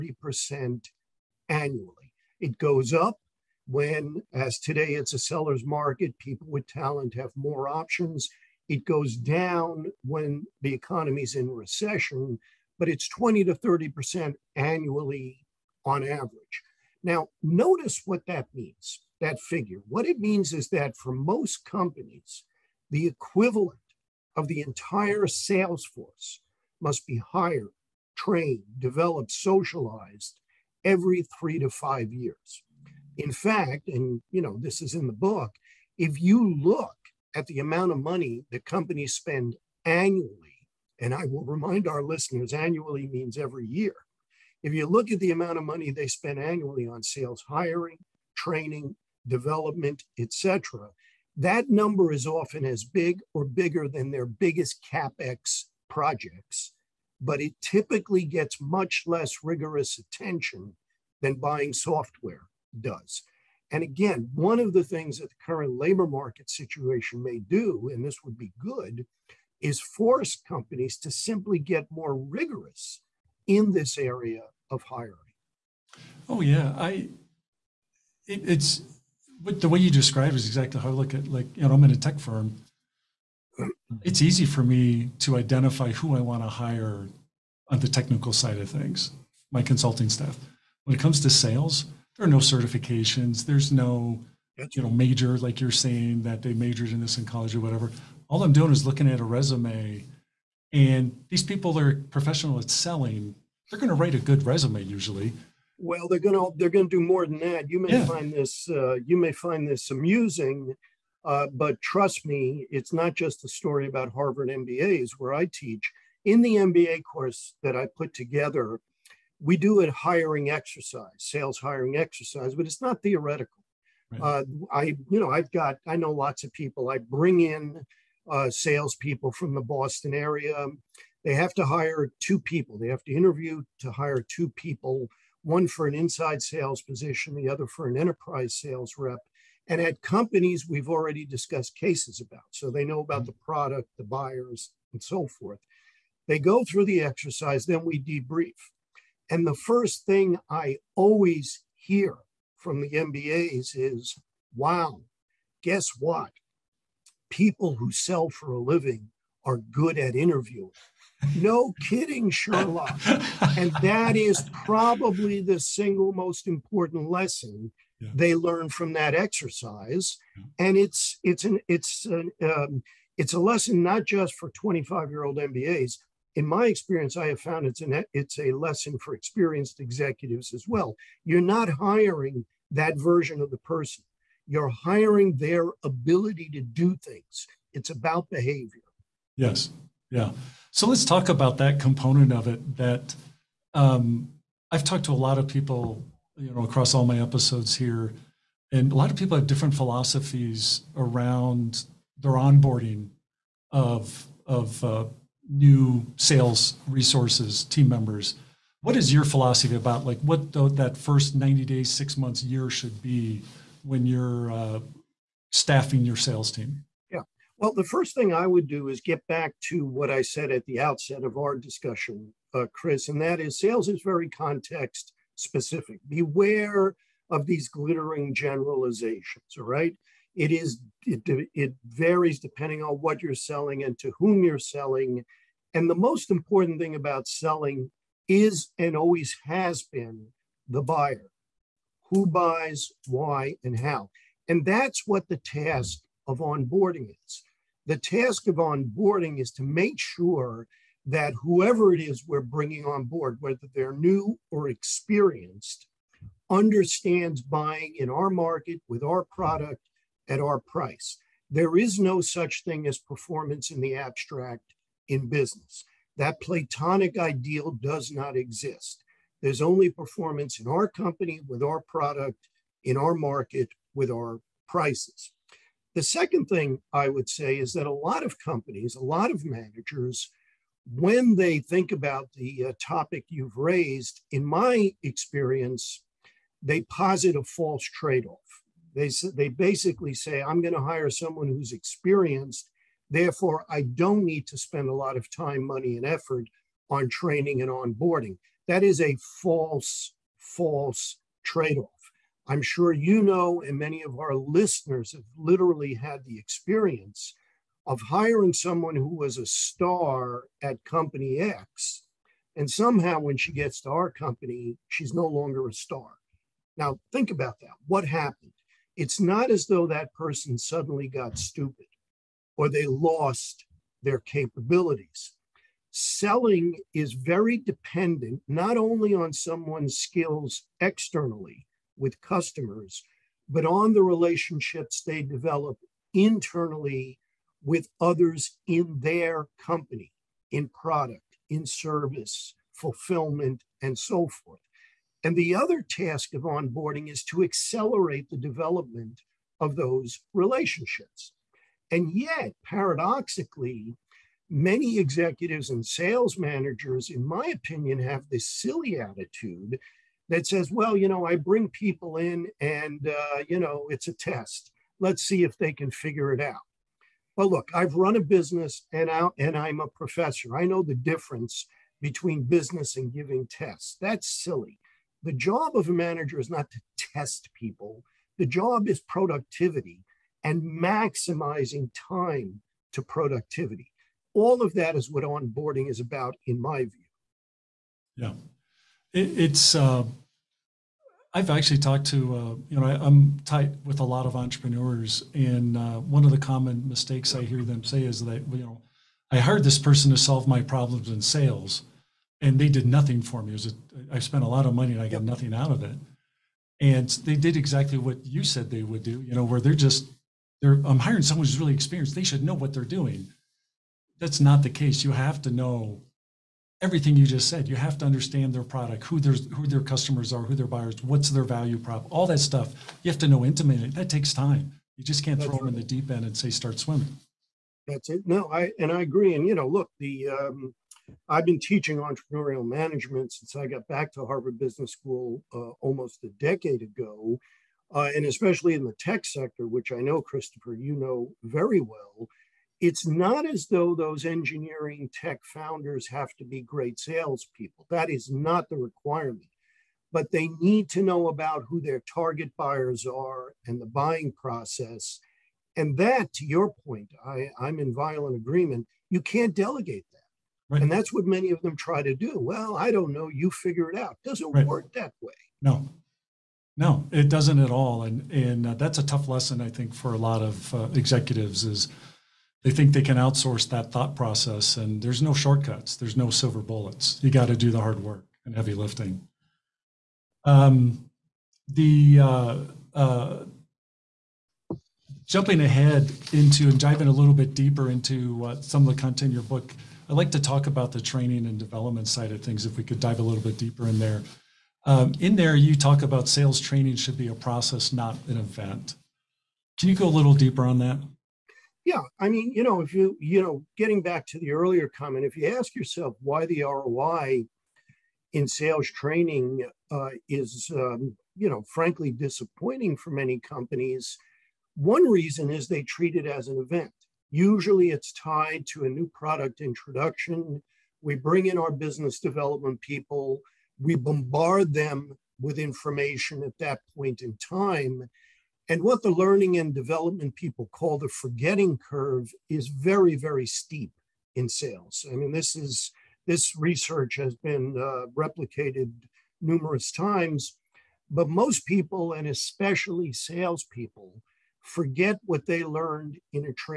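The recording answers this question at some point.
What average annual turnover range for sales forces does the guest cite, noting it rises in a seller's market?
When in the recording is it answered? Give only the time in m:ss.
0:13.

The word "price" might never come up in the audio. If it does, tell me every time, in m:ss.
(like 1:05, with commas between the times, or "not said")
4:20, 4:34.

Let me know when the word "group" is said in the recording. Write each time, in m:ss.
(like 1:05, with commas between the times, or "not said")
not said.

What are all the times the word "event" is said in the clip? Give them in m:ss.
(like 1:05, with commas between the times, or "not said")
8:18, 8:36.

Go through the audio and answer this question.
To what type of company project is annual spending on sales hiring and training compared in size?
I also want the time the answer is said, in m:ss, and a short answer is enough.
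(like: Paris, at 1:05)
capex projects, at 0:54.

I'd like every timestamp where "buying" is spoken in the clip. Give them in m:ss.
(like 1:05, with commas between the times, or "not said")
1:01, 4:17, 7:33.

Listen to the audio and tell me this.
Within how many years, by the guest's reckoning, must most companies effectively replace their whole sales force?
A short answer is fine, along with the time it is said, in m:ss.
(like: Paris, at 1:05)
three to five years, at 0:31.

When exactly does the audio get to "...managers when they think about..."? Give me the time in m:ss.
4:39.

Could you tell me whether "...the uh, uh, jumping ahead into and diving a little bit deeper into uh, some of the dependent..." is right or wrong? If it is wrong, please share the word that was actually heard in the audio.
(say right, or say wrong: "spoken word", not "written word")
wrong: "content", not "dependent".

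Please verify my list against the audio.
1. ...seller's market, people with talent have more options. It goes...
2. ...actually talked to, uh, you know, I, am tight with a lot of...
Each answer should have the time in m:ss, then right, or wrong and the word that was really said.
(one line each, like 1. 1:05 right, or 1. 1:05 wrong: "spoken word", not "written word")
1. 0:05 right
2. 6:31 right.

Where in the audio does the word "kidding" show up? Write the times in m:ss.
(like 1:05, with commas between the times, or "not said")
2:41.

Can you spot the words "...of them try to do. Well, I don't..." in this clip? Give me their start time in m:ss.
7:41.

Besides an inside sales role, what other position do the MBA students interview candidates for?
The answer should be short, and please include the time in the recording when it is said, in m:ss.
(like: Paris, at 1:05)
enterprise sales rep, at 2:17.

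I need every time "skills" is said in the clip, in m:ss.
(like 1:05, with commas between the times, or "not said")
5:29.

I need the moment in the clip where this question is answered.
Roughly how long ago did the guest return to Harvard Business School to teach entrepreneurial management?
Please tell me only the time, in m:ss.
7:15.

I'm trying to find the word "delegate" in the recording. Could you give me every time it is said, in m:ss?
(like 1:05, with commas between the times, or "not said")
7:39.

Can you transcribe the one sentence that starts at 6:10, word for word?
I know the difference between business and giving tests.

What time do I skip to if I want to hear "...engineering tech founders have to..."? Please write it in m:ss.
7:24.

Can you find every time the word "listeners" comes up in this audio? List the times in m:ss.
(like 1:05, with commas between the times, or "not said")
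0:42, 5:04.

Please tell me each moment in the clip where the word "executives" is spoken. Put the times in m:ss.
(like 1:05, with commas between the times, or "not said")
2:59, 5:54, 7:50.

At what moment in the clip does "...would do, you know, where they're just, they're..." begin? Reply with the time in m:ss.
6:48.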